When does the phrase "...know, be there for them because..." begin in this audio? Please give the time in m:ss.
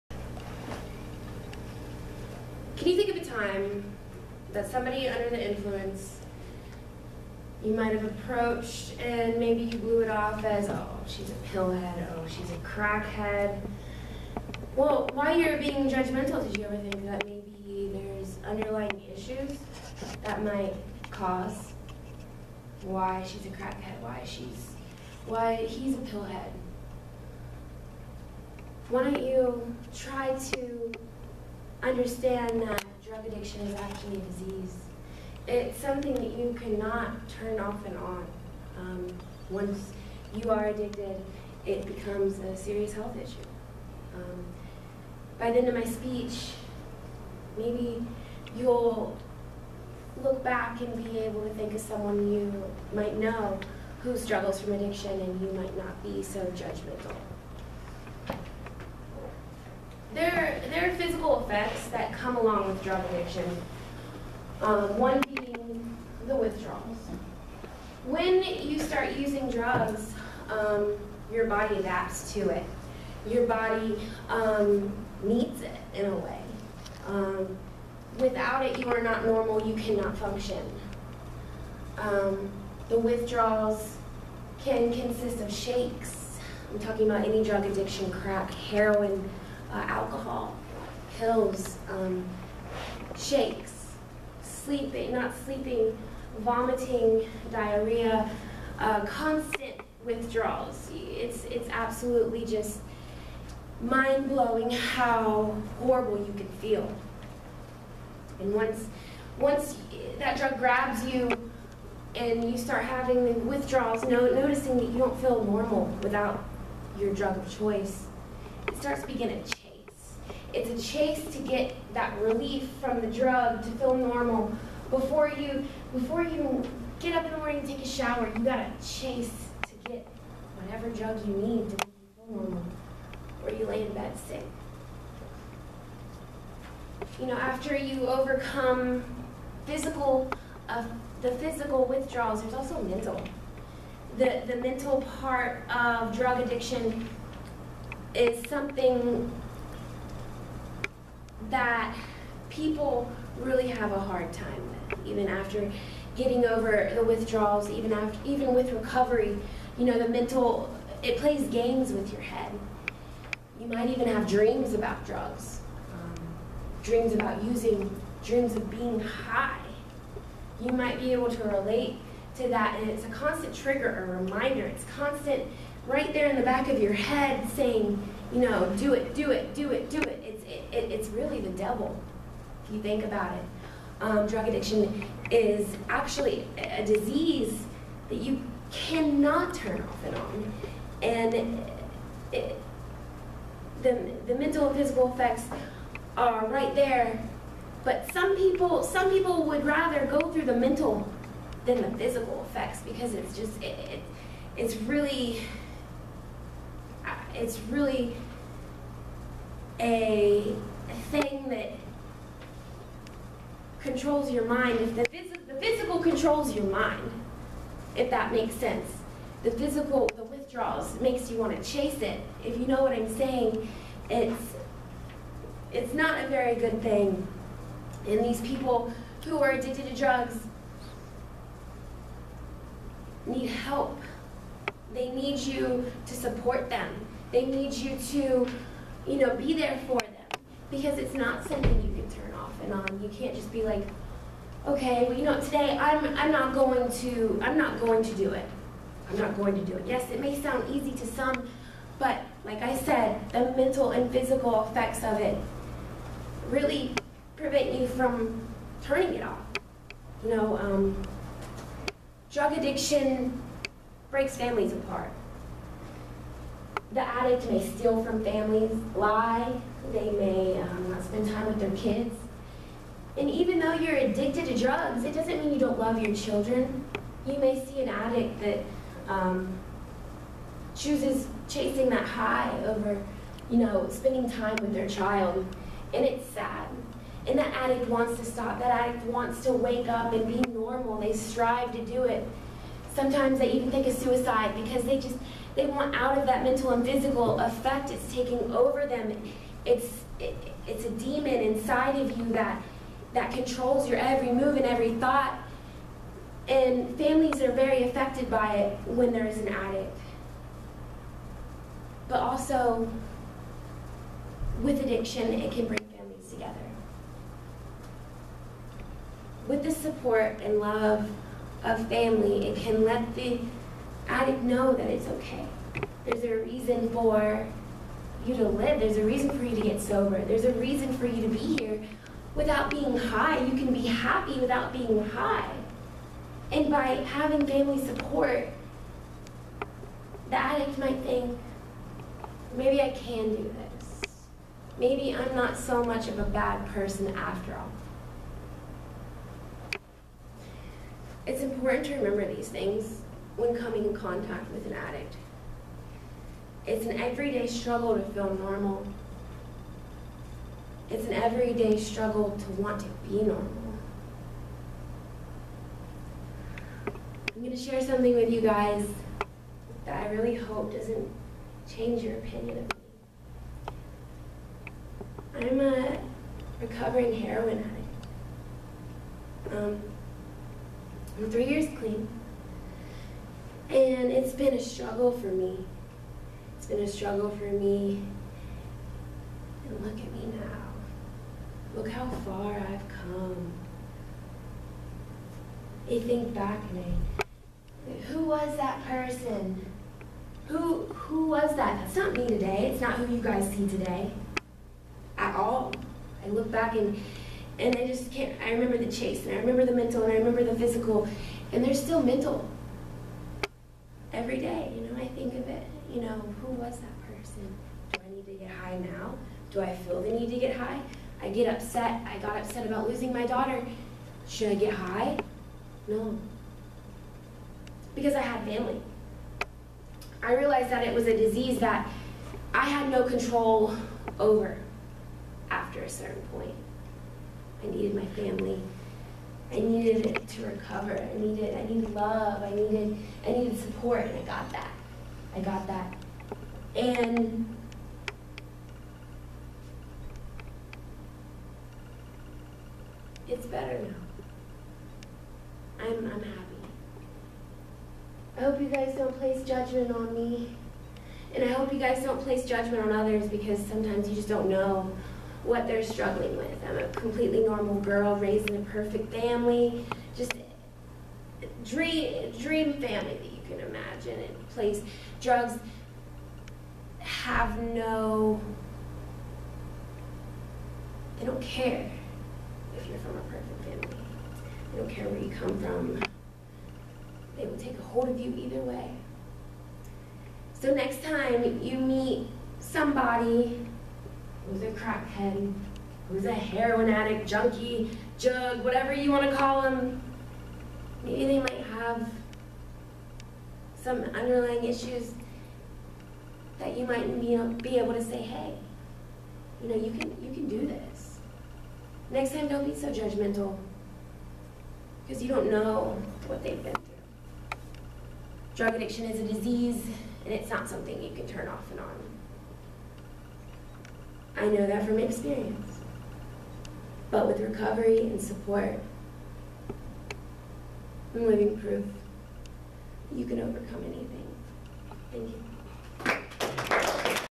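3:59.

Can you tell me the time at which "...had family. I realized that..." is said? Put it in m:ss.
7:08.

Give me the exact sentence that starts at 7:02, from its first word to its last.
I got upset about losing my daughter.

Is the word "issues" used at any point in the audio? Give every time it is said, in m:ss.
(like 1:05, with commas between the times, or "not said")
0:19, 0:43, 8:24.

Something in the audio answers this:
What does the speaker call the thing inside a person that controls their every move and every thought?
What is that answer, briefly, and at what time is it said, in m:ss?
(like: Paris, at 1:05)
a demon, at 5:00.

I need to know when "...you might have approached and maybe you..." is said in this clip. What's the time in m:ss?
0:07.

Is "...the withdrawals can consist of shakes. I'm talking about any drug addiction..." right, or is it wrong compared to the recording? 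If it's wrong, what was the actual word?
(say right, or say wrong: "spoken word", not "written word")
right.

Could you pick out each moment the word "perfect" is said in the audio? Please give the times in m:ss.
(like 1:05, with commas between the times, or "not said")
7:48, 8:03.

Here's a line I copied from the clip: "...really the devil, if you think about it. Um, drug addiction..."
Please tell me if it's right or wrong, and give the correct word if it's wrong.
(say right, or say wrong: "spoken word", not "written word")
right.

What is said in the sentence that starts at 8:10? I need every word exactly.
So next time you meet somebody who's a crackhead, who's a heroin addict, junkie, jug, whatever you want to call them.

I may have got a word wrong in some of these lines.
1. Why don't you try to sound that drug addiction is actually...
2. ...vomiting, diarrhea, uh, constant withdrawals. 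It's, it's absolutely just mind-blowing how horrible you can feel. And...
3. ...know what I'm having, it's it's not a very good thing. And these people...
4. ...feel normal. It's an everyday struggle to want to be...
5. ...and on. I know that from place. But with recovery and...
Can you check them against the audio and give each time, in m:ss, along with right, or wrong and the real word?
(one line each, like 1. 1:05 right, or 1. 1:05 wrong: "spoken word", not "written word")
1. 0:28 wrong: "understand", not "sound"
2. 1:36 right
3. 3:42 wrong: "saying", not "having"
4. 5:58 right
5. 8:41 wrong: "experience", not "place".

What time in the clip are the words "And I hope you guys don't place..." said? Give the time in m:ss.
7:41.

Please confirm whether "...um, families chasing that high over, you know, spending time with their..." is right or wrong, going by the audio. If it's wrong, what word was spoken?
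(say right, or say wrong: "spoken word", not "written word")
wrong: "chooses", not "families".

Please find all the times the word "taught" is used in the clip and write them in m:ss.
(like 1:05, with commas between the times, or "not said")
not said.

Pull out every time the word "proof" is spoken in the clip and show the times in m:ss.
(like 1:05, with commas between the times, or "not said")
8:51.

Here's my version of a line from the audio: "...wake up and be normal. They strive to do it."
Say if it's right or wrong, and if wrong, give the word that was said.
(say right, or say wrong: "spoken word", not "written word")
right.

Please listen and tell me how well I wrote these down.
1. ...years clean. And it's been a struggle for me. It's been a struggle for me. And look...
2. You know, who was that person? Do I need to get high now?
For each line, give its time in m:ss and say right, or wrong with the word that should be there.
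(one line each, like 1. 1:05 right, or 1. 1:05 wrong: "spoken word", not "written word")
1. 6:21 right
2. 6:55 right.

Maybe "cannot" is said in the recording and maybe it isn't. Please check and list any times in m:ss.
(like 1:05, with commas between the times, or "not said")
0:36, 1:19, 3:08.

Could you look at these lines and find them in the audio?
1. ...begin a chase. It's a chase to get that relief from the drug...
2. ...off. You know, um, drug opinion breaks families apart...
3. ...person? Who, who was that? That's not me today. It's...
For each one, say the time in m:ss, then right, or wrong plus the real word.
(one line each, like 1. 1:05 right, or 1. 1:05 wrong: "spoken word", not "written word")
1. 1:59 right
2. 4:19 wrong: "addiction", not "opinion"
3. 6:38 right.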